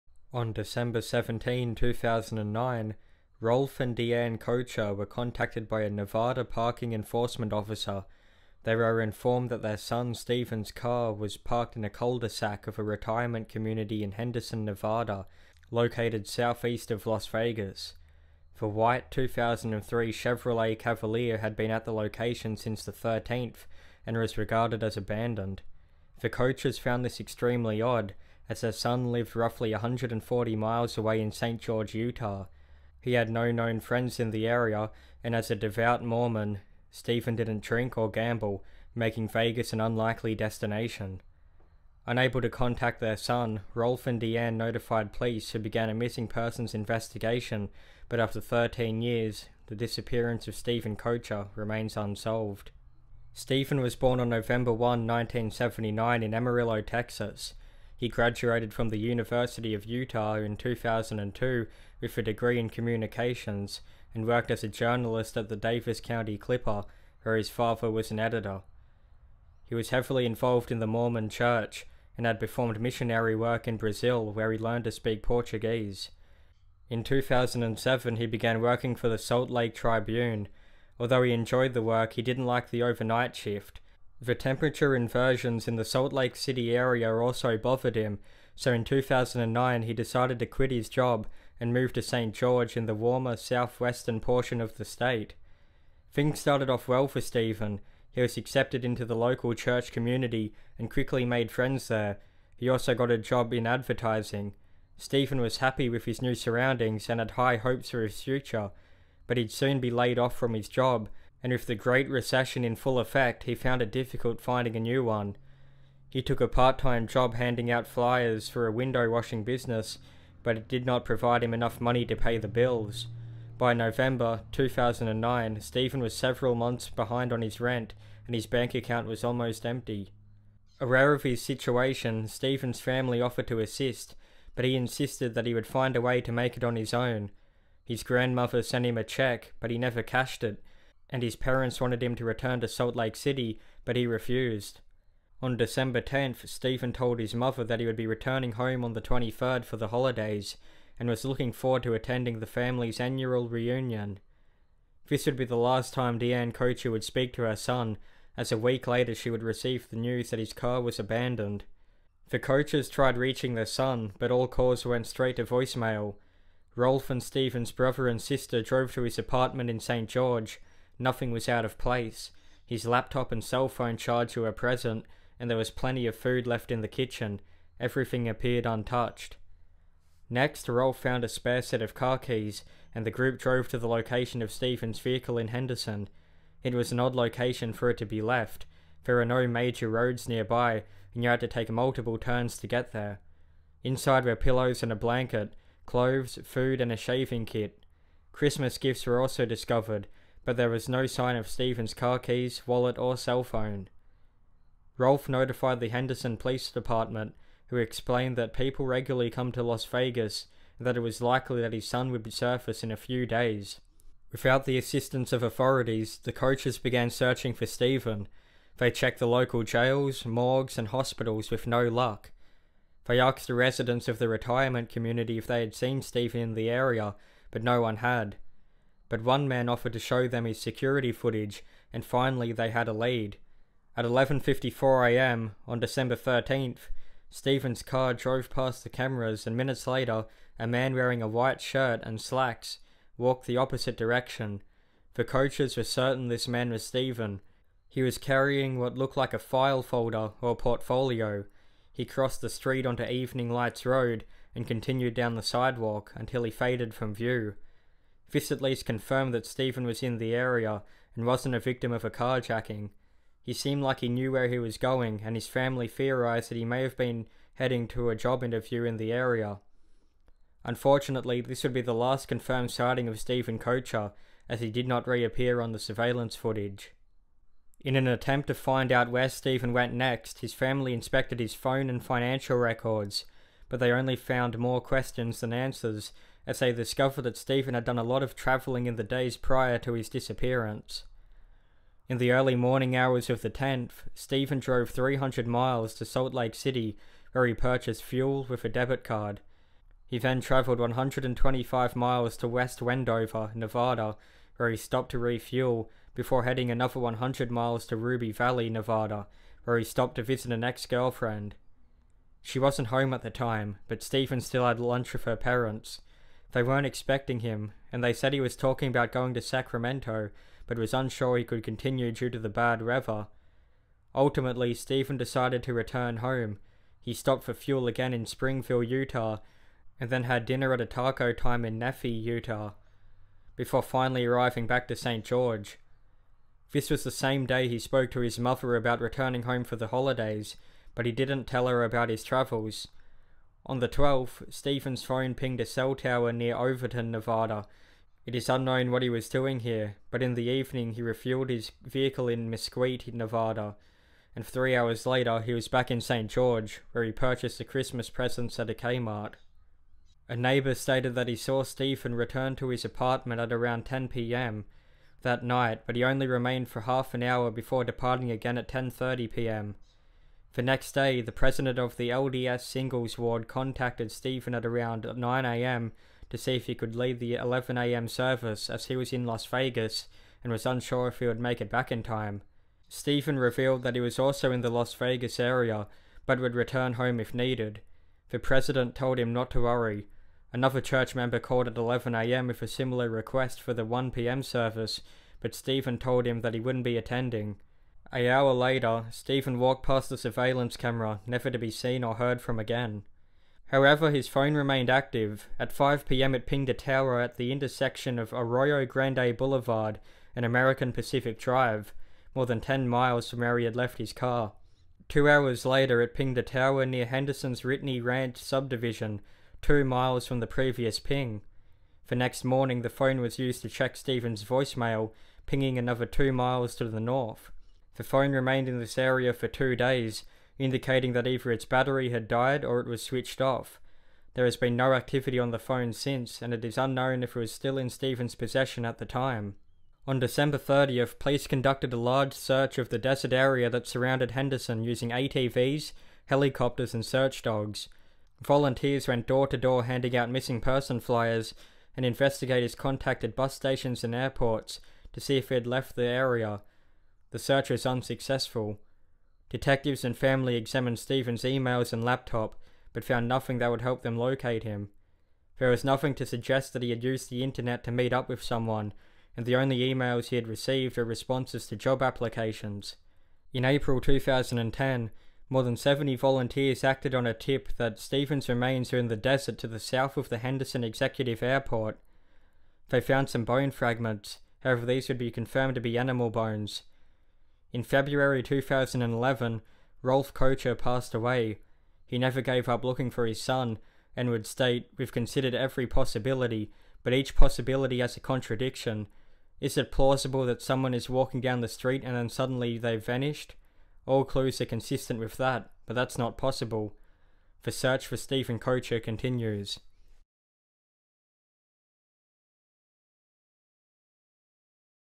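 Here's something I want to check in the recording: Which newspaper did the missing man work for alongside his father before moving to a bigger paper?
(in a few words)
Davis County Clipper.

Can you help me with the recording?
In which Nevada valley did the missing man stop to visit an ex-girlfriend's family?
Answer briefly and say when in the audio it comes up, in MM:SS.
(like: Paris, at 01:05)
Ruby Valley, at 05:07.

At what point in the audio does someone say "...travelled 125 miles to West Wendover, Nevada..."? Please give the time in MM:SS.
05:00.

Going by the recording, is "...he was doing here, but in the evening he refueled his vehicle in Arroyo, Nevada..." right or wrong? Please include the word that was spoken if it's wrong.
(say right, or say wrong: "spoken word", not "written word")
wrong: "Mesquite", not "Arroyo".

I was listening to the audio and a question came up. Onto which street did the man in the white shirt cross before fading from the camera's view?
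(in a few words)
Evening Lights Road.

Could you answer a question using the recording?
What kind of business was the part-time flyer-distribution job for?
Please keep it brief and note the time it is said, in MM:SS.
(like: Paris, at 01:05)
window washing, at 01:58.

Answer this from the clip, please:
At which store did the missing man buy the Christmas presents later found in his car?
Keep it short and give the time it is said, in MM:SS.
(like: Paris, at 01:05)
Kmart, at 05:58.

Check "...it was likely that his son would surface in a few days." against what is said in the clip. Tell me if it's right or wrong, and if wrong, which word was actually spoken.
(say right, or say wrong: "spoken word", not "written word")
right.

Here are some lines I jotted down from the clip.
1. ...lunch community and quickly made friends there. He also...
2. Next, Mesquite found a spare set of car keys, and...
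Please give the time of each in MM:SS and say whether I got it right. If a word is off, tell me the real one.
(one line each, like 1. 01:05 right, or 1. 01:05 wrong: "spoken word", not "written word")
1. 01:39 wrong: "church", not "lunch"
2. 03:00 wrong: "Rolf", not "Mesquite".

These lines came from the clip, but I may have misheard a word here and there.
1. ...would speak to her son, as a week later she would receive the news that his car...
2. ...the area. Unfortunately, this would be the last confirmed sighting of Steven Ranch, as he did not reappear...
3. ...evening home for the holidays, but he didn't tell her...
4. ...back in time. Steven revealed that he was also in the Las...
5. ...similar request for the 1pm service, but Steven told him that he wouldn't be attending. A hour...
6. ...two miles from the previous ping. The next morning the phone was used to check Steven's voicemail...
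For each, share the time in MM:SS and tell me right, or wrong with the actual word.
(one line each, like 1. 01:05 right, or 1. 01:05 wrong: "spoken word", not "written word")
1. 02:36 right
2. 04:28 wrong: "Koecher", not "Ranch"
3. 05:39 wrong: "returning", not "evening"
4. 06:21 right
5. 06:32 right
6. 06:59 right.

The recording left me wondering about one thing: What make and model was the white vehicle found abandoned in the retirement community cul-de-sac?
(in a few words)
2003 Chevrolet Cavalier.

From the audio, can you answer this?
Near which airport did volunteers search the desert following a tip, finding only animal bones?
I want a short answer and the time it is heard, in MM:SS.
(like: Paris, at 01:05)
Henderson Executive Airport, at 08:00.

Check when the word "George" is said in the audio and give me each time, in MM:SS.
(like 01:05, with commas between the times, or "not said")
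00:31, 01:32, 02:50, 05:35, 05:56.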